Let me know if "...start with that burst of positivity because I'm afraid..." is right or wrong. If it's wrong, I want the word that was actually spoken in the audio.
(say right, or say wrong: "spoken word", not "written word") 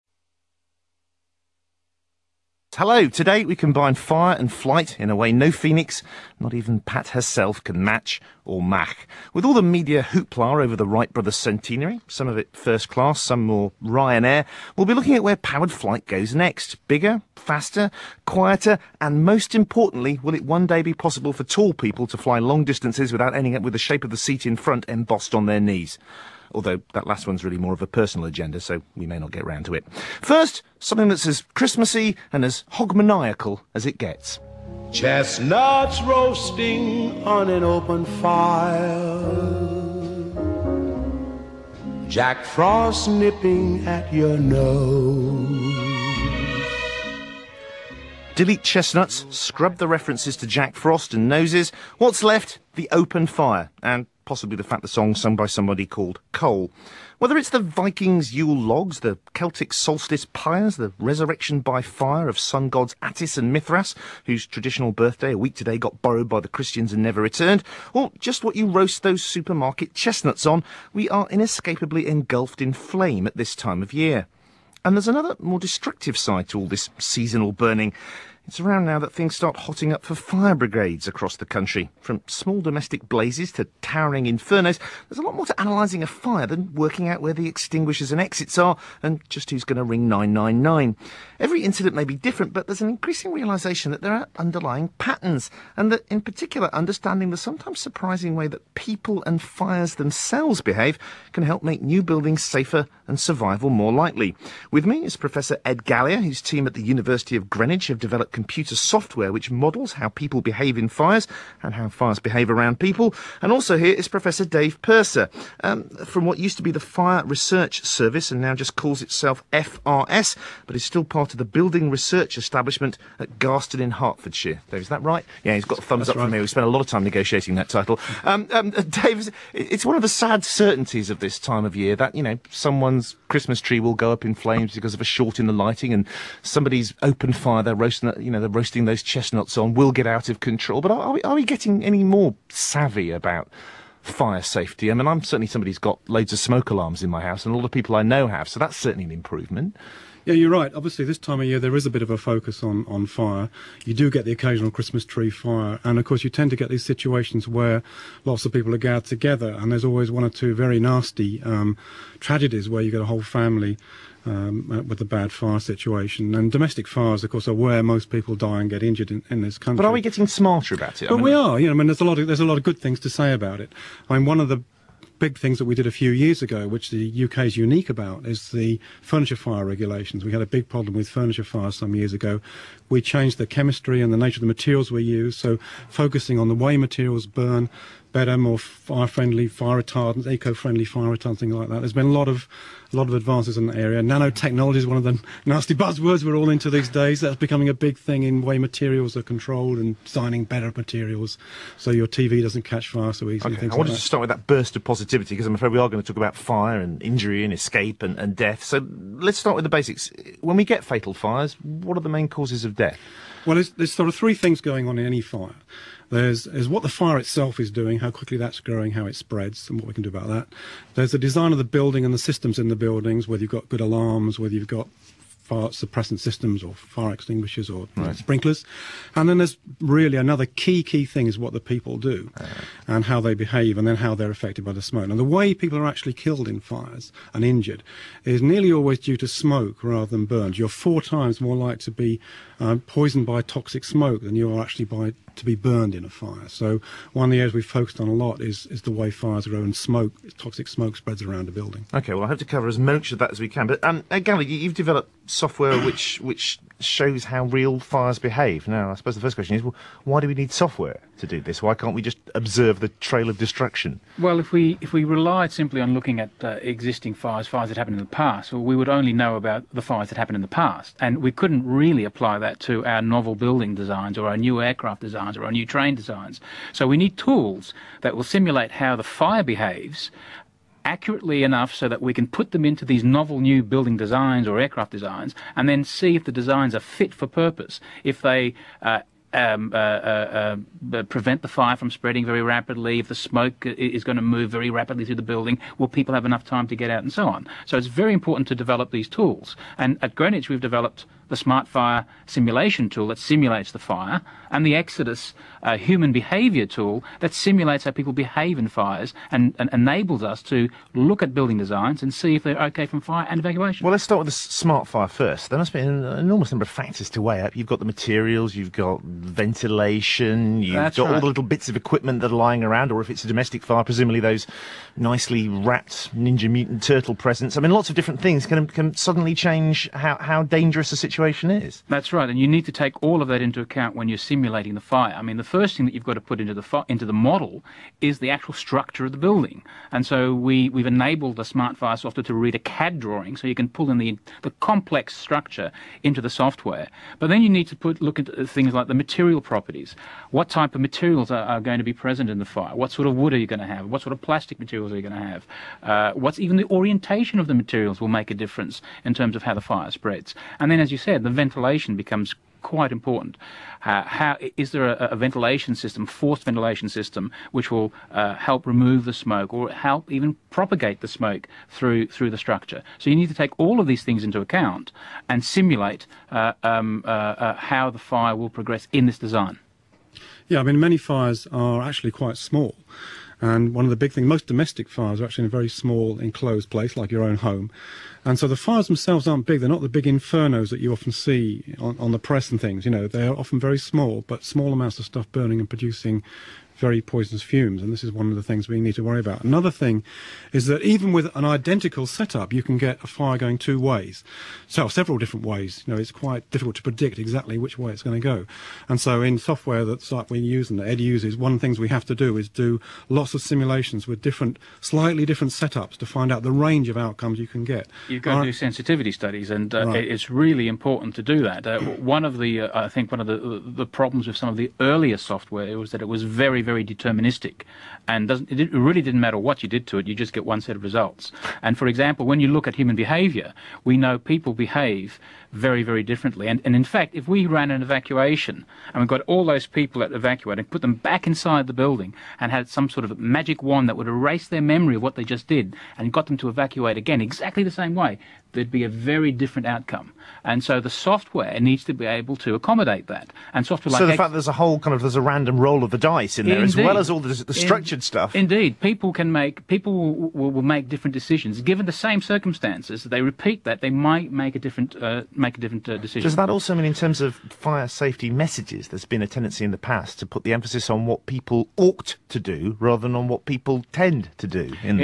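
right.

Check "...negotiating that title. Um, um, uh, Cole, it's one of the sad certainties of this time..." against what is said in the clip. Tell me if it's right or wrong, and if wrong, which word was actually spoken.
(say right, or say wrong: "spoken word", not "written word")
wrong: "Dave", not "Cole".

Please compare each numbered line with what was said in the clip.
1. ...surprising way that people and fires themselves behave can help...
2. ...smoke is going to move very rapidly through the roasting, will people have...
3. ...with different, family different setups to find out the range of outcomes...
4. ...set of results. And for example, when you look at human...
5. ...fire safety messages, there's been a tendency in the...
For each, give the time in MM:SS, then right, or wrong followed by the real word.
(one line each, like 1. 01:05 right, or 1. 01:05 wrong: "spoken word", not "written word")
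1. 01:37 right
2. 04:53 wrong: "building", not "roasting"
3. 06:54 wrong: "slightly", not "family"
4. 07:10 right
5. 07:47 right.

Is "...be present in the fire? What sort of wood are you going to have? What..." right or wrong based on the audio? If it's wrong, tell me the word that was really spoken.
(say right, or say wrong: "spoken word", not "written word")
right.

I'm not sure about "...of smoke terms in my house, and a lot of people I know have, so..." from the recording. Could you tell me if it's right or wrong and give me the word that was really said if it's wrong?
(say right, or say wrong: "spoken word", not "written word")
wrong: "alarms", not "terms".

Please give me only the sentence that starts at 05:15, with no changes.
There must be an enormous number of factors to weigh up.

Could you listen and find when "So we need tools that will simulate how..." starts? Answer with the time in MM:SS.
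04:36.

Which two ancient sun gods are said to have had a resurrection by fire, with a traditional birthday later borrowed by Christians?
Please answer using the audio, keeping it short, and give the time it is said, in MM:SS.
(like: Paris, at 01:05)
Attis and Mithras, at 01:03.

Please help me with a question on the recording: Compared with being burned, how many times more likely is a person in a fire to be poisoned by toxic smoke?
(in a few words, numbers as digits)
4 times.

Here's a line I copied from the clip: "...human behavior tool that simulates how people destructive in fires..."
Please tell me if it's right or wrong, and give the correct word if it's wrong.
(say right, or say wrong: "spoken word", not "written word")
wrong: "behave", not "destructive".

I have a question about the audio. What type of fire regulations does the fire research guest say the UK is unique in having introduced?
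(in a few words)
Furniture fire regulations.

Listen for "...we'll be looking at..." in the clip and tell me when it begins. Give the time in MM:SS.
00:14.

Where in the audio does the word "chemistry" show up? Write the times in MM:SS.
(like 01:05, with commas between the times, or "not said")
03:03.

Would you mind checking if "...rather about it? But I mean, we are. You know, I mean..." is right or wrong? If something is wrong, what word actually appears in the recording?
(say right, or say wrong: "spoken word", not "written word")
wrong: "smarter", not "rather".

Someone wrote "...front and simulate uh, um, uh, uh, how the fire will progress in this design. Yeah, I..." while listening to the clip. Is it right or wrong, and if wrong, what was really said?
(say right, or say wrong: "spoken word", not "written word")
wrong: "account", not "front".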